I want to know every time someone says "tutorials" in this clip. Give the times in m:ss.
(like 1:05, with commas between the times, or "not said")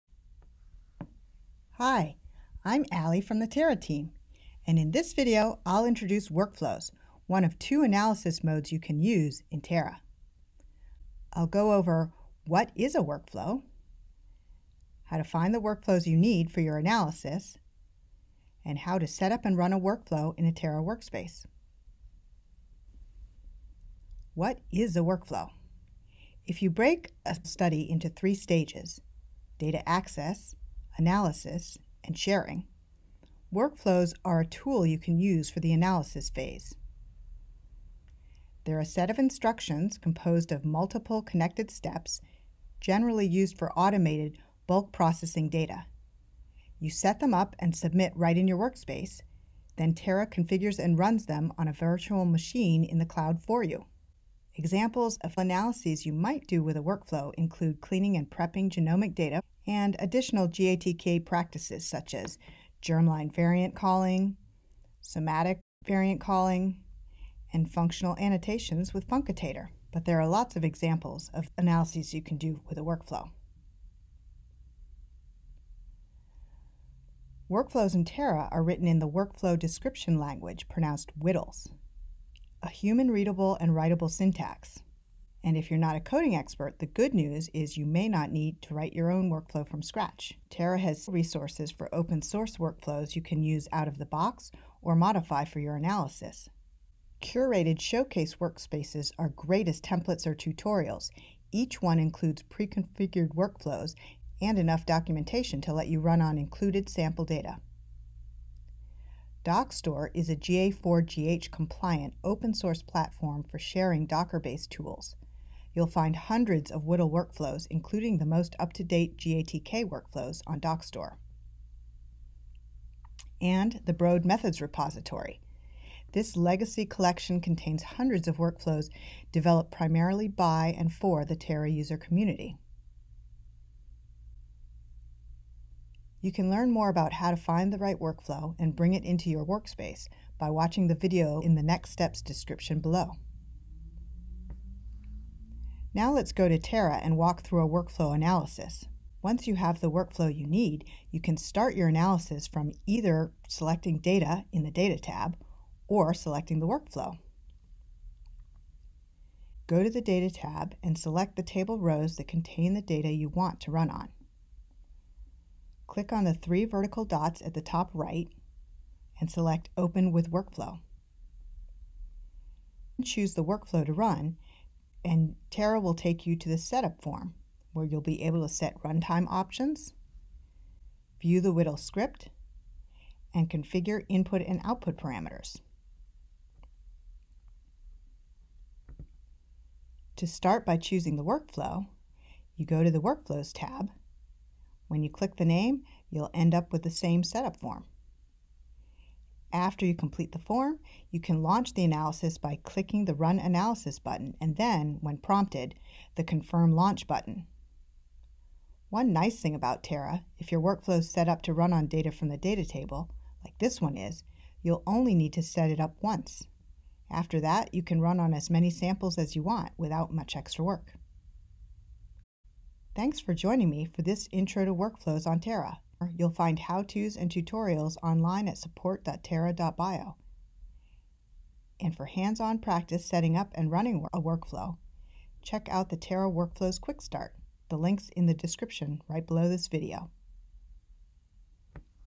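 1:40, 3:47.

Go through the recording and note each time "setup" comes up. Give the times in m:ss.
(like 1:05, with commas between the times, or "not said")
2:56, 3:17.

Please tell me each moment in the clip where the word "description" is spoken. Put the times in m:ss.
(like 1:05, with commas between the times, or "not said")
1:19, 2:22, 3:58.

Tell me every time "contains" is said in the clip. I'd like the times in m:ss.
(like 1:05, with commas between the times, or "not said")
2:07, 2:42.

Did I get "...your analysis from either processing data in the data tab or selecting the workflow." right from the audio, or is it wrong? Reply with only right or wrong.
wrong.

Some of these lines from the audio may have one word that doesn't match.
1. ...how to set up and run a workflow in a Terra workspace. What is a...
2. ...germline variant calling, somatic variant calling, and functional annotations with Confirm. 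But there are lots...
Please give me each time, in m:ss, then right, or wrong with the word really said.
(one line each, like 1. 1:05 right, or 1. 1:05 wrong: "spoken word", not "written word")
1. 0:18 right
2. 1:02 wrong: "Funcotator", not "Confirm".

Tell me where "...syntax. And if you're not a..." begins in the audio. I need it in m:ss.
1:24.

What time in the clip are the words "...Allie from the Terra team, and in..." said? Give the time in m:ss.
0:02.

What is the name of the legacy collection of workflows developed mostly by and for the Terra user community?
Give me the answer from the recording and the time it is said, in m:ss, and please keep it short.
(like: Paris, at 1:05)
Broad Methods repository, at 2:03.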